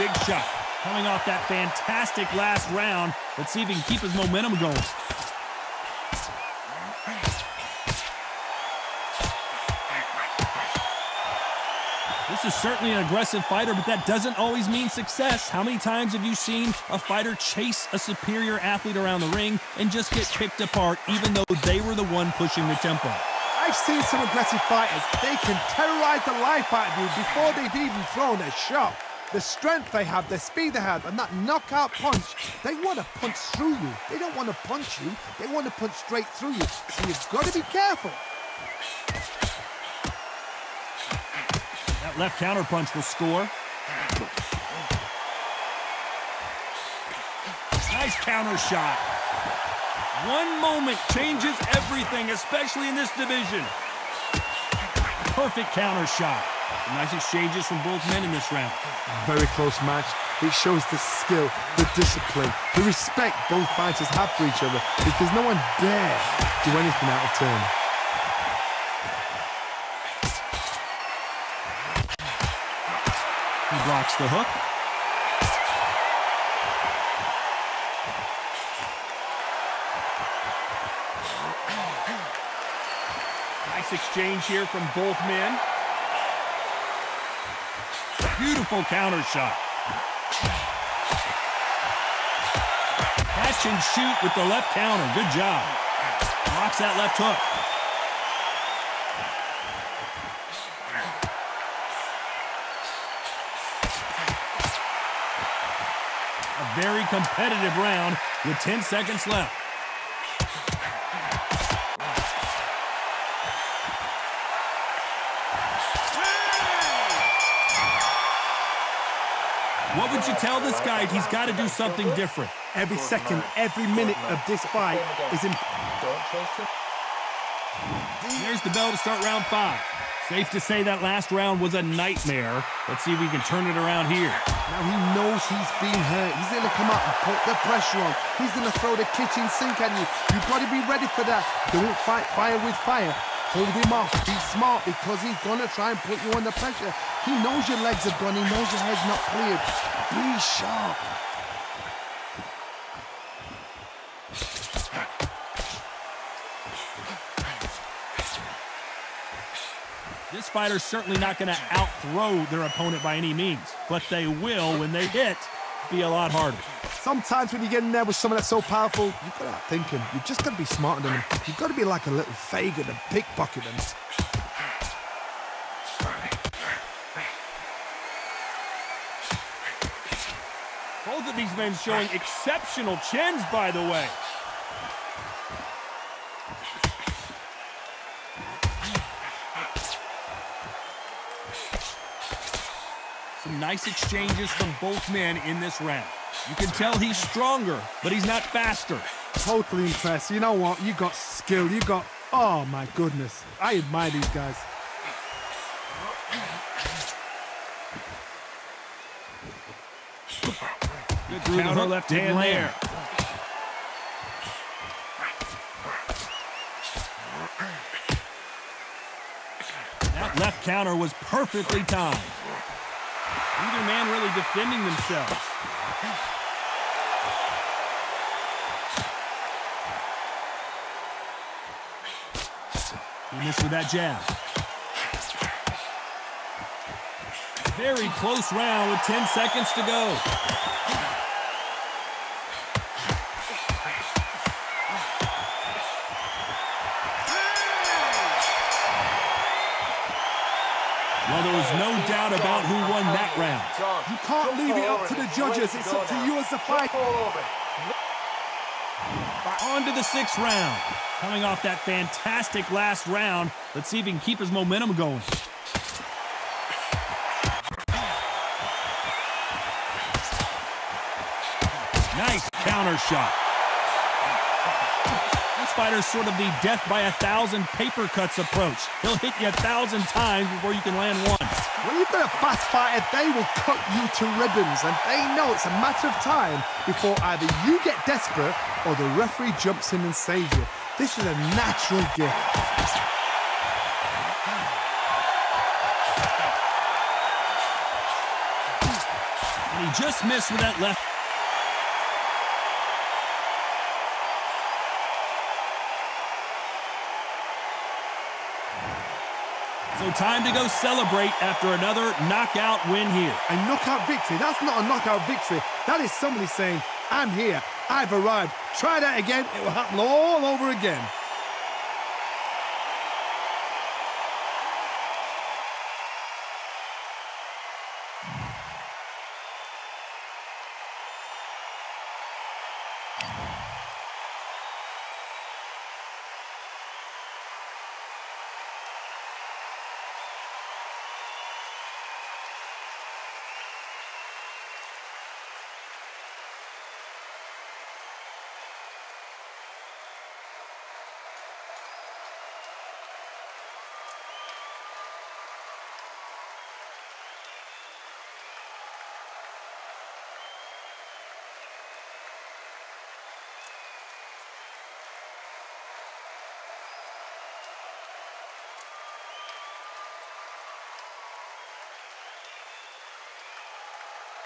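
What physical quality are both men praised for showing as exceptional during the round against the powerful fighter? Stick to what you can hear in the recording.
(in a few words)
Chins.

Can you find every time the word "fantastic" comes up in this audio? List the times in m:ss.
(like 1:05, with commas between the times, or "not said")
0:01, 4:21.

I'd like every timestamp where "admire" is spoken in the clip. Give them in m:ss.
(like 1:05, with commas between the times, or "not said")
3:23.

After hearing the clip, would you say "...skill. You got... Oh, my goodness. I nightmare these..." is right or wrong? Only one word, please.
wrong.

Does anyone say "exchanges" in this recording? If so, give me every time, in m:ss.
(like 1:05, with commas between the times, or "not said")
0:57, 1:23, 3:13.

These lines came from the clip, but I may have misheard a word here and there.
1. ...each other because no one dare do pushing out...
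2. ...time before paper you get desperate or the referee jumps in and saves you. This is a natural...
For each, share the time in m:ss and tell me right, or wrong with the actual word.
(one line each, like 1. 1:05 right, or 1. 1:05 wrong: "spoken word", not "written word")
1. 1:04 wrong: "anything", not "pushing"
2. 4:46 wrong: "either", not "paper".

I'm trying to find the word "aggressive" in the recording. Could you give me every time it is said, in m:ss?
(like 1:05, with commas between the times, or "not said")
0:13, 0:24.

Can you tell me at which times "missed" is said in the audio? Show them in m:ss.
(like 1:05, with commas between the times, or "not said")
3:53, 5:00.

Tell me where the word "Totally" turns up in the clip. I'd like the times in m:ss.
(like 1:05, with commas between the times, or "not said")
3:19.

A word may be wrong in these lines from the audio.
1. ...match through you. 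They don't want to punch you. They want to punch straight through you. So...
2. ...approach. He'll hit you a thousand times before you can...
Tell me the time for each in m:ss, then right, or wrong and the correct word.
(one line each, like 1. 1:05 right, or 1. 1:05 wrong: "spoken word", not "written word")
1. 0:33 wrong: "punch", not "match"
2. 4:38 right.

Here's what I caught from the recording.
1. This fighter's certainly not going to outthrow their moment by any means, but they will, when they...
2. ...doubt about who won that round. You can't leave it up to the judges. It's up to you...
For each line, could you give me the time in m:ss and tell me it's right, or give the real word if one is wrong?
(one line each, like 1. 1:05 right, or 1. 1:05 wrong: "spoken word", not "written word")
1. 2:40 wrong: "opponent", not "moment"
2. 4:12 right.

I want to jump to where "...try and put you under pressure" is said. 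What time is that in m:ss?
2:25.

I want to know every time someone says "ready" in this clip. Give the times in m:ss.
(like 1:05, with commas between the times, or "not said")
2:20.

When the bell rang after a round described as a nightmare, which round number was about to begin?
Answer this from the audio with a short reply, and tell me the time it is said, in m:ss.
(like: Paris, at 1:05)
5, at 2:09.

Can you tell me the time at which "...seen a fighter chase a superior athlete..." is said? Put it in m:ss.
0:16.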